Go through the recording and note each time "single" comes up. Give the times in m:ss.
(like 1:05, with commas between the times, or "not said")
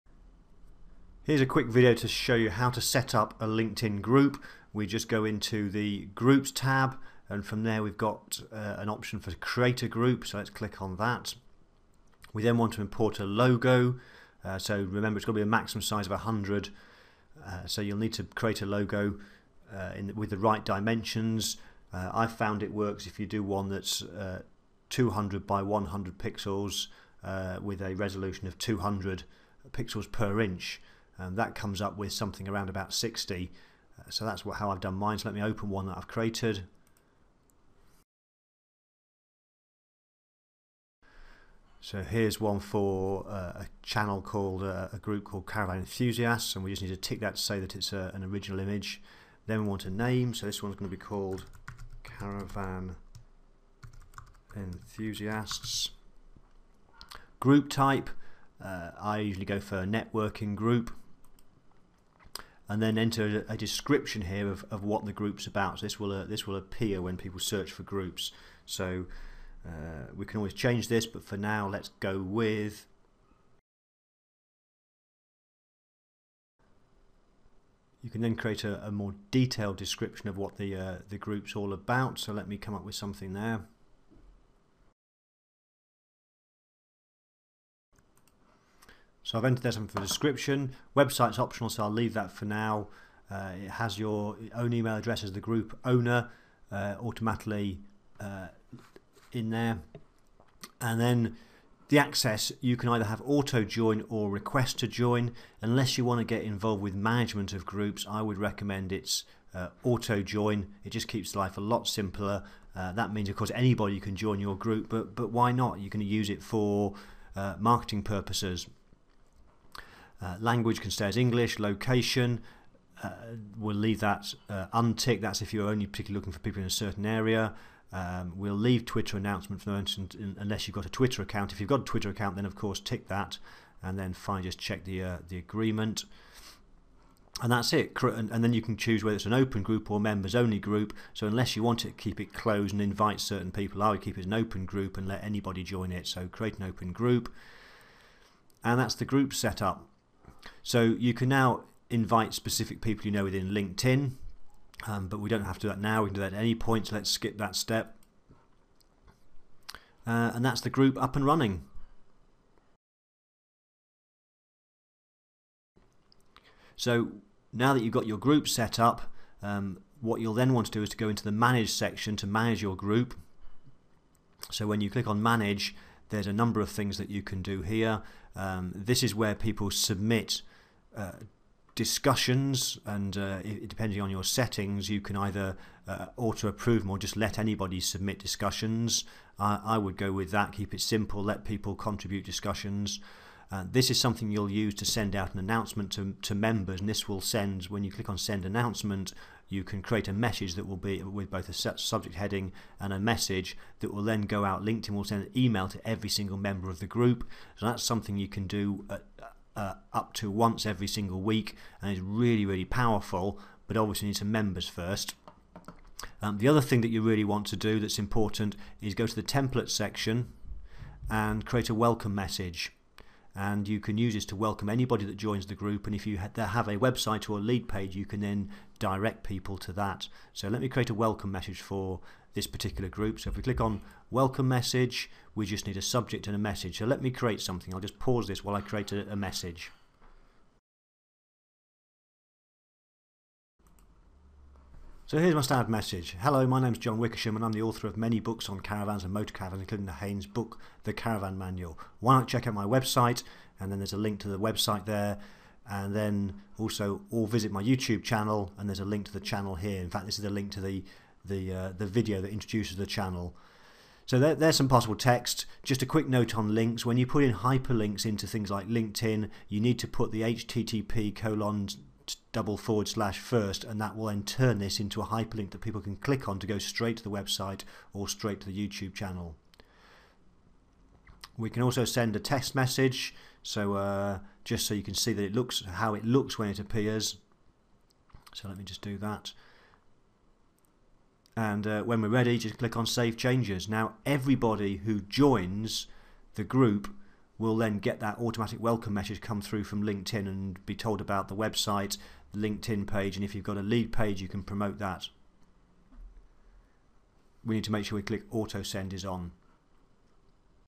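3:26, 3:30.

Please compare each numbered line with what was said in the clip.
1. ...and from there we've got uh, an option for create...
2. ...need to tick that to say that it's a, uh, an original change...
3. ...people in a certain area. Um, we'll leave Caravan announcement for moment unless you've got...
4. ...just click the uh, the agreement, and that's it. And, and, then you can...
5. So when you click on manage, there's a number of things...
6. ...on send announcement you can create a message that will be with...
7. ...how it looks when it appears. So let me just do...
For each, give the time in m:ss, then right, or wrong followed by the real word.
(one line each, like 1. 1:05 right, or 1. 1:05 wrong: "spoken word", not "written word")
1. 0:07 right
2. 0:46 wrong: "image", not "change"
3. 2:06 wrong: "Twitter", not "Caravan"
4. 2:14 wrong: "check", not "click"
5. 2:54 right
6. 3:18 right
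7. 4:45 right.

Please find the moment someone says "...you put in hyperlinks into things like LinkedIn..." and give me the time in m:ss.
4:26.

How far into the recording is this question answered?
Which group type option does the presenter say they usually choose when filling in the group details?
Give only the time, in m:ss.
0:59.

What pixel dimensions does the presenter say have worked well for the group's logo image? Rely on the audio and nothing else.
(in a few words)
200 by 100 pixels.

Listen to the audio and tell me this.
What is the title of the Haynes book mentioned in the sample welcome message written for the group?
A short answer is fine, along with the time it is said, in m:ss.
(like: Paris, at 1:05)
The Caravan Manual, at 4:10.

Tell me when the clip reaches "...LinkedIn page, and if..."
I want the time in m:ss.
5:02.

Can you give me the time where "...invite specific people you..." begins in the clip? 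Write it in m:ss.
2:31.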